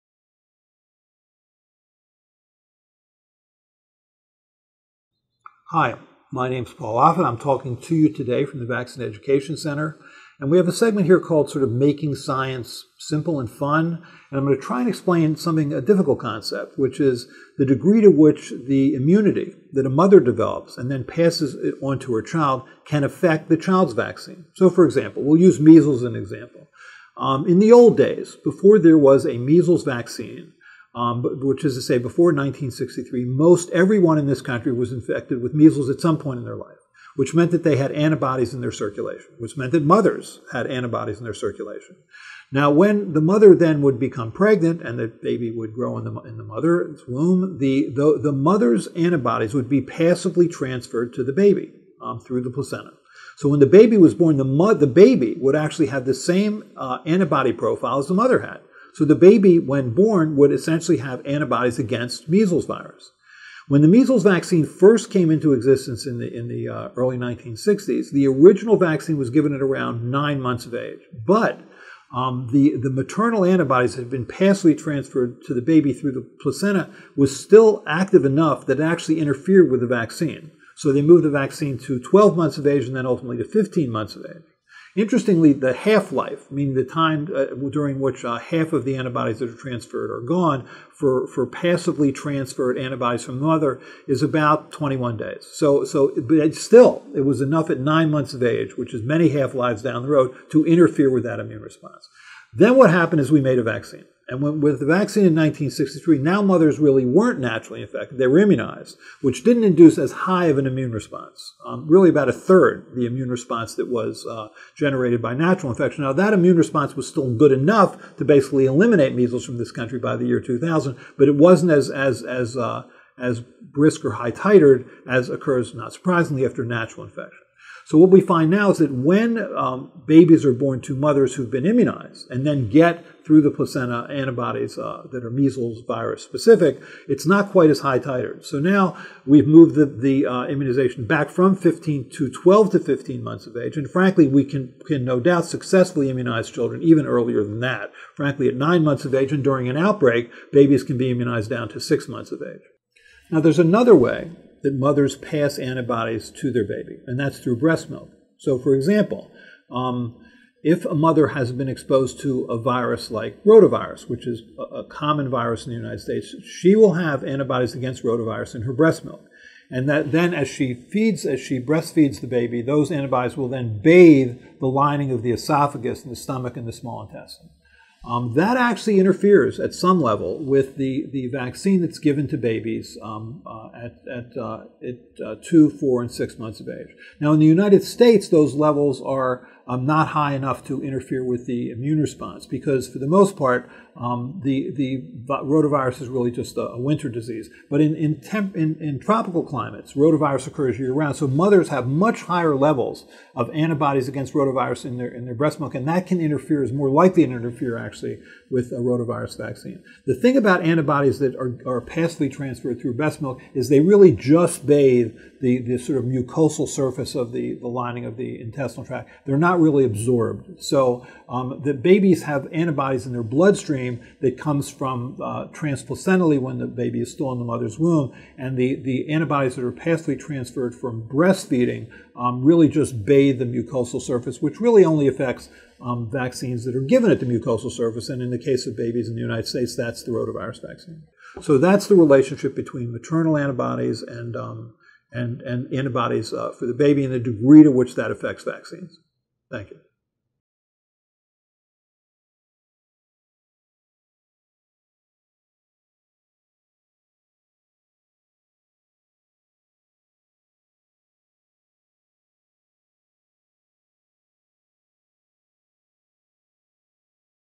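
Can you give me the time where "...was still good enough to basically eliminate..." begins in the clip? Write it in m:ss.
1:56.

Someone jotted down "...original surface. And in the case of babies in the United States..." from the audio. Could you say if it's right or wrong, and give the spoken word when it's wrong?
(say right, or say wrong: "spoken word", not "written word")
wrong: "mucosal", not "original".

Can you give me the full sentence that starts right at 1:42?
Then what happened is we made a vaccine.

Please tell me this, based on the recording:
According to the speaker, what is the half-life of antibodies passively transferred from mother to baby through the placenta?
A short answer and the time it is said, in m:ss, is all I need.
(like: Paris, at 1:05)
21 days, at 1:34.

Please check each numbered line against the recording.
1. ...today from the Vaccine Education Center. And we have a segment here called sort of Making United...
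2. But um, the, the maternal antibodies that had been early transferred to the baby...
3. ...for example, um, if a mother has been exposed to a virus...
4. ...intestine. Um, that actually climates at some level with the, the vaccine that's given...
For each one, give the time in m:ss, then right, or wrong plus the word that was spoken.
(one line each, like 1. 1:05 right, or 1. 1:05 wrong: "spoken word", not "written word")
1. 0:08 wrong: "Science", not "United"
2. 1:11 wrong: "passively", not "early"
3. 2:38 right
4. 2:57 wrong: "interferes", not "climates".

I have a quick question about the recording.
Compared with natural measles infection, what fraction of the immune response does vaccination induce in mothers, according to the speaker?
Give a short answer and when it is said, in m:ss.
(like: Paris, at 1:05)
a third, at 1:52.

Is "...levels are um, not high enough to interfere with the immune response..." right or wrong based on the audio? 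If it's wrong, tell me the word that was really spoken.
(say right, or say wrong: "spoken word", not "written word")
right.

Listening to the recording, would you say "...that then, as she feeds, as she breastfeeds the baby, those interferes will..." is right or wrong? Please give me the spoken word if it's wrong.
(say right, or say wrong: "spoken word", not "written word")
wrong: "antibodies", not "interferes".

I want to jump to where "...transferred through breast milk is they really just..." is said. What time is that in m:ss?
3:32.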